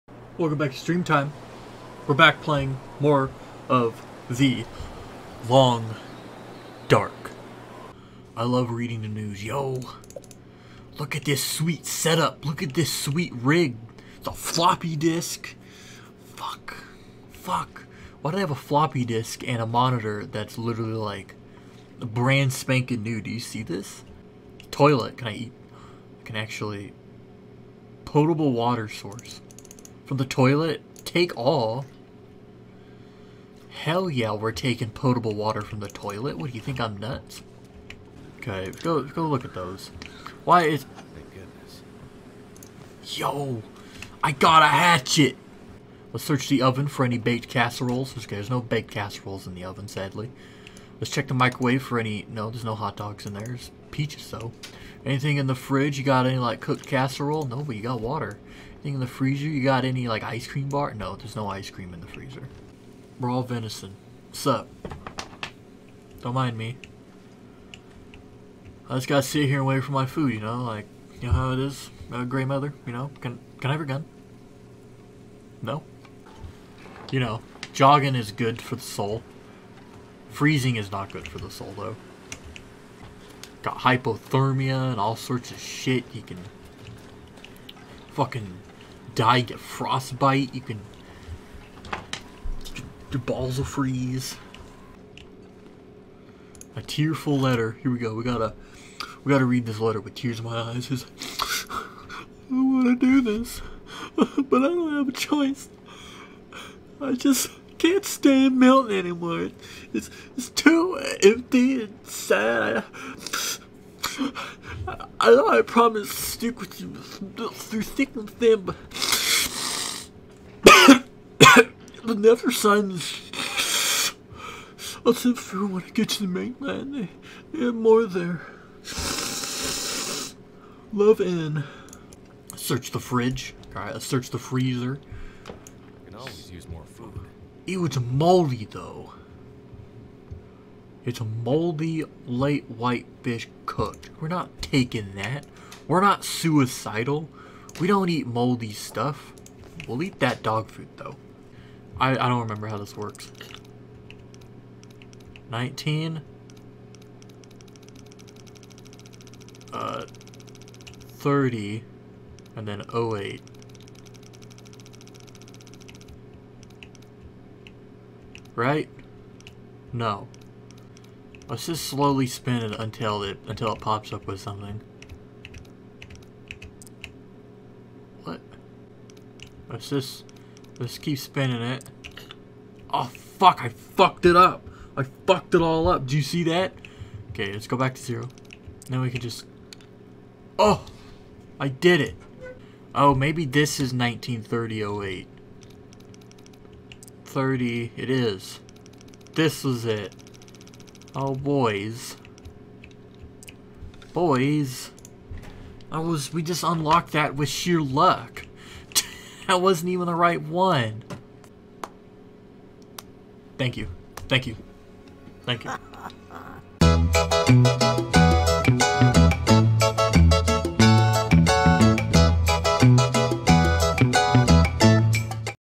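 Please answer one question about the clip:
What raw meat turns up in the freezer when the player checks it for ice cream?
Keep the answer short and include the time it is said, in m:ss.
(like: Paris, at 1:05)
raw venison, at 1:03.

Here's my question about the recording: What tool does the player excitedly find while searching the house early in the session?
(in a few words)
hatchet.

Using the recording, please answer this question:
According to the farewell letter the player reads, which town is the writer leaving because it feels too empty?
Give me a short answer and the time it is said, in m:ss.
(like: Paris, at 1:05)
Milton, at 1:48.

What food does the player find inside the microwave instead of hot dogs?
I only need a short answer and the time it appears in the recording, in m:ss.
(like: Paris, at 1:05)
peaches, at 0:53.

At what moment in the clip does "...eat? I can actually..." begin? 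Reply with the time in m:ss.
0:25.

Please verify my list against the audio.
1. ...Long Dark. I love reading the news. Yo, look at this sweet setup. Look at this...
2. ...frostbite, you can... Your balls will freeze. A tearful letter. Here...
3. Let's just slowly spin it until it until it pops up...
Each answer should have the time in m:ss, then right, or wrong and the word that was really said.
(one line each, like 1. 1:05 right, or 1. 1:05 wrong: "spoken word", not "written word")
1. 0:05 right
2. 1:29 right
3. 2:51 right.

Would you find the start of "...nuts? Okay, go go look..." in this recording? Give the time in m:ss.
0:36.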